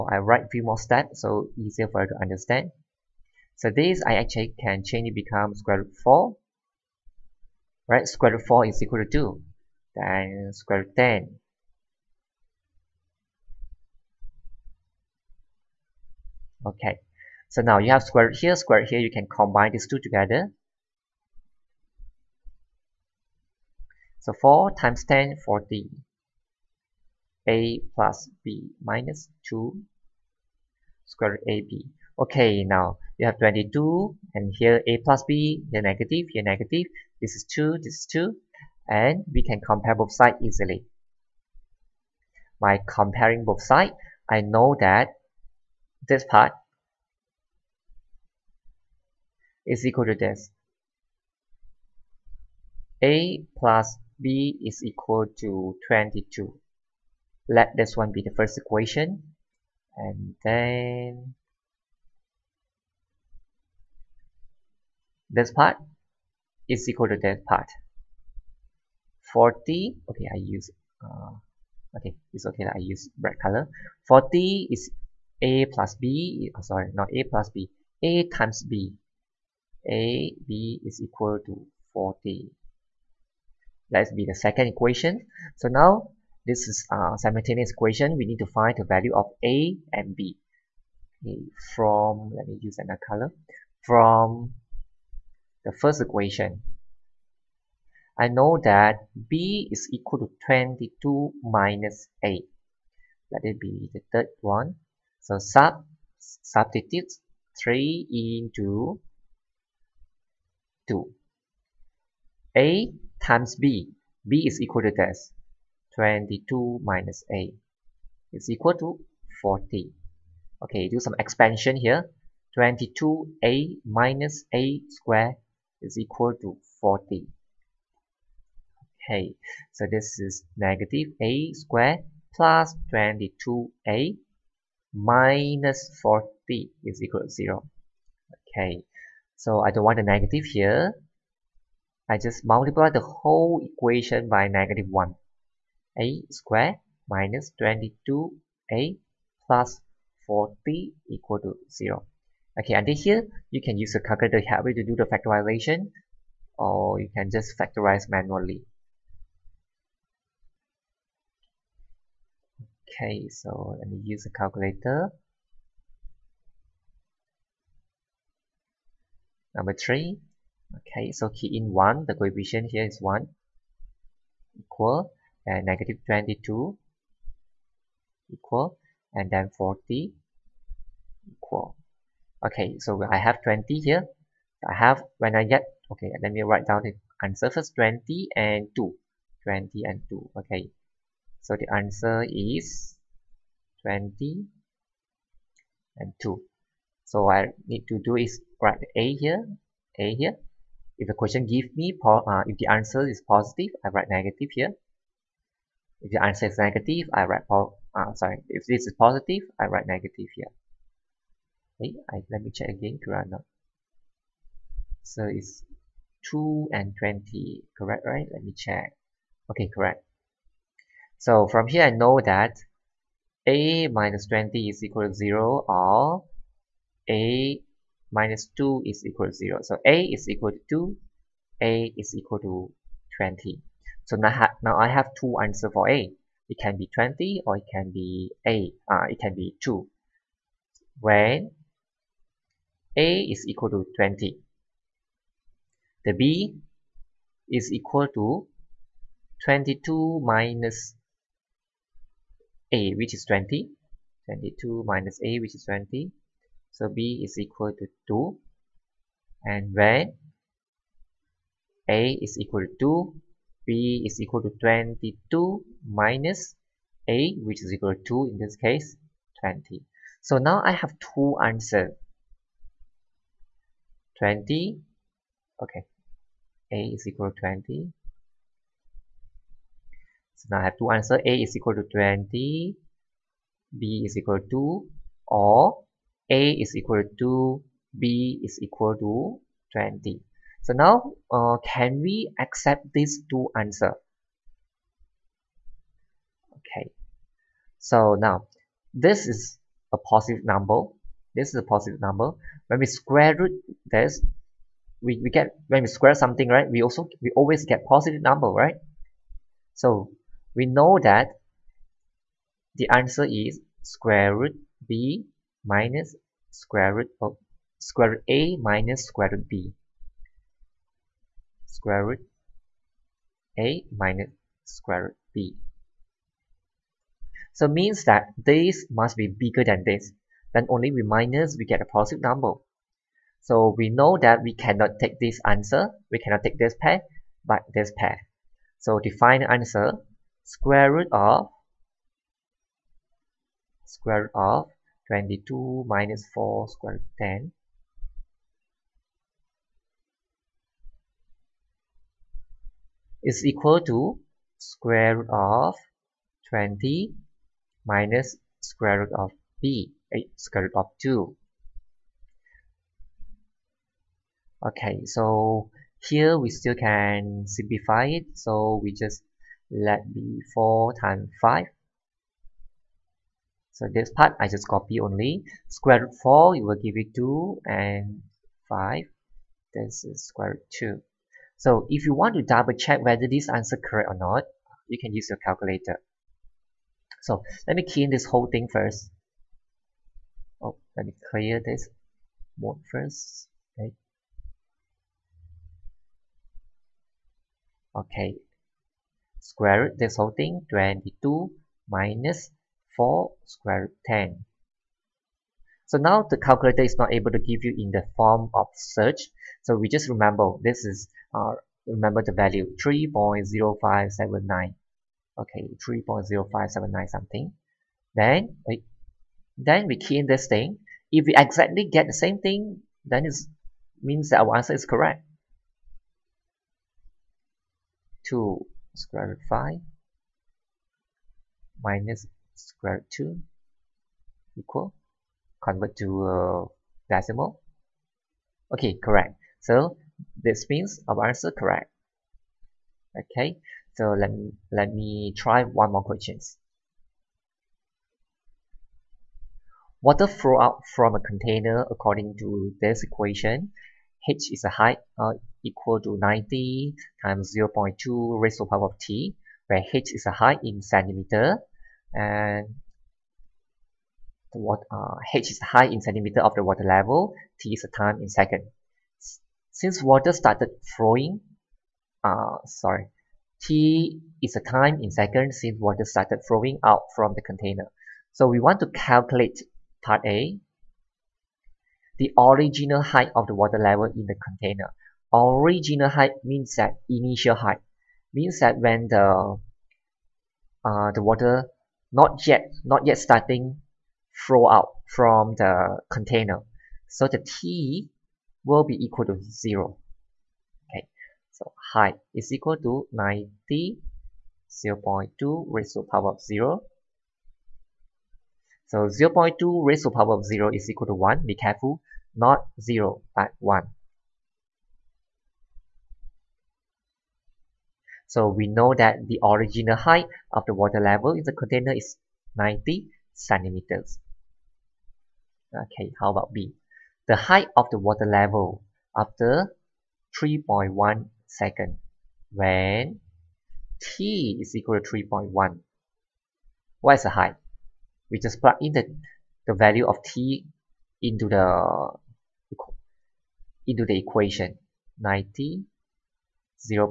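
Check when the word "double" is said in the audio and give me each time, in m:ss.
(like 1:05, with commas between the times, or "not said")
6:22.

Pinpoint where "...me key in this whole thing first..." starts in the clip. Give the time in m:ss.
6:27.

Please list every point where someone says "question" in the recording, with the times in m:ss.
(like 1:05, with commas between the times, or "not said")
3:21, 7:26.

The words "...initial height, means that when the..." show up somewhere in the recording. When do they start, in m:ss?
8:07.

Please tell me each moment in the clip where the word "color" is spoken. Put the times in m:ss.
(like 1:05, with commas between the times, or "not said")
1:13, 1:33.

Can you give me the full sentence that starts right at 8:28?
So 0 0.2 raised to power of 0 is equal to 1.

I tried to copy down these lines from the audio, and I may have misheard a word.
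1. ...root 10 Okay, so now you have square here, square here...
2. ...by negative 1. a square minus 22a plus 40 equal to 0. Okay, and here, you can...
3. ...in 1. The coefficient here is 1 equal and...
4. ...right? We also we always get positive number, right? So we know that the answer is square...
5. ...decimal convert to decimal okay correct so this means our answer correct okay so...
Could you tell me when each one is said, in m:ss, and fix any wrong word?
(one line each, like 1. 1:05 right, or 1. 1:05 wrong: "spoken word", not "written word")
1. 0:10 right
2. 2:24 right
3. 2:51 right
4. 5:06 right
5. 7:14 wrong: "equal", not "decimal".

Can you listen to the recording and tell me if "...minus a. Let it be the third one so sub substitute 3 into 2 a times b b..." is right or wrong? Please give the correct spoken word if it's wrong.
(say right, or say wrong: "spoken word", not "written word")
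right.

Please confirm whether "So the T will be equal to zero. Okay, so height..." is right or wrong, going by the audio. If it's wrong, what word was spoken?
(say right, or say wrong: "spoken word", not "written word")
right.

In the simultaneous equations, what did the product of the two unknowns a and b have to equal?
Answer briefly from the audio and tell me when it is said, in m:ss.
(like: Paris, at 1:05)
40, at 1:19.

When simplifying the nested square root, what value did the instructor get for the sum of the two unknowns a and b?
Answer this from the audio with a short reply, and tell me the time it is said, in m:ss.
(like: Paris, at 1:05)
22, at 0:53.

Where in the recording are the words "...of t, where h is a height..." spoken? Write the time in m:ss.
7:38.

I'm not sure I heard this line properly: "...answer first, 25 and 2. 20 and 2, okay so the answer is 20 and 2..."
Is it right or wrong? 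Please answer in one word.
wrong.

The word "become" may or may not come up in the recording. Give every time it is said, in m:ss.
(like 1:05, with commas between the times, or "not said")
0:05.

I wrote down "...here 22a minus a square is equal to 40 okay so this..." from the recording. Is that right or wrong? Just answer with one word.
right.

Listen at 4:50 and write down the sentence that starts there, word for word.
So now uh, can we accept these two answers?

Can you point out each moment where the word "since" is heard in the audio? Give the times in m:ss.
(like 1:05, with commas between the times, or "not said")
7:49, 7:55.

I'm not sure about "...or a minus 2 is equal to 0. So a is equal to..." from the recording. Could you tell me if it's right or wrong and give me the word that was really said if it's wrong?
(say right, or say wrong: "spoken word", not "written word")
right.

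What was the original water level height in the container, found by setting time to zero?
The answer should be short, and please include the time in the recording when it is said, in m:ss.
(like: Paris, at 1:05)
90 centimeters, at 8:42.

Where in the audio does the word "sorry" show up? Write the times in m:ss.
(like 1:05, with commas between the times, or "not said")
1:16, 3:28, 7:52.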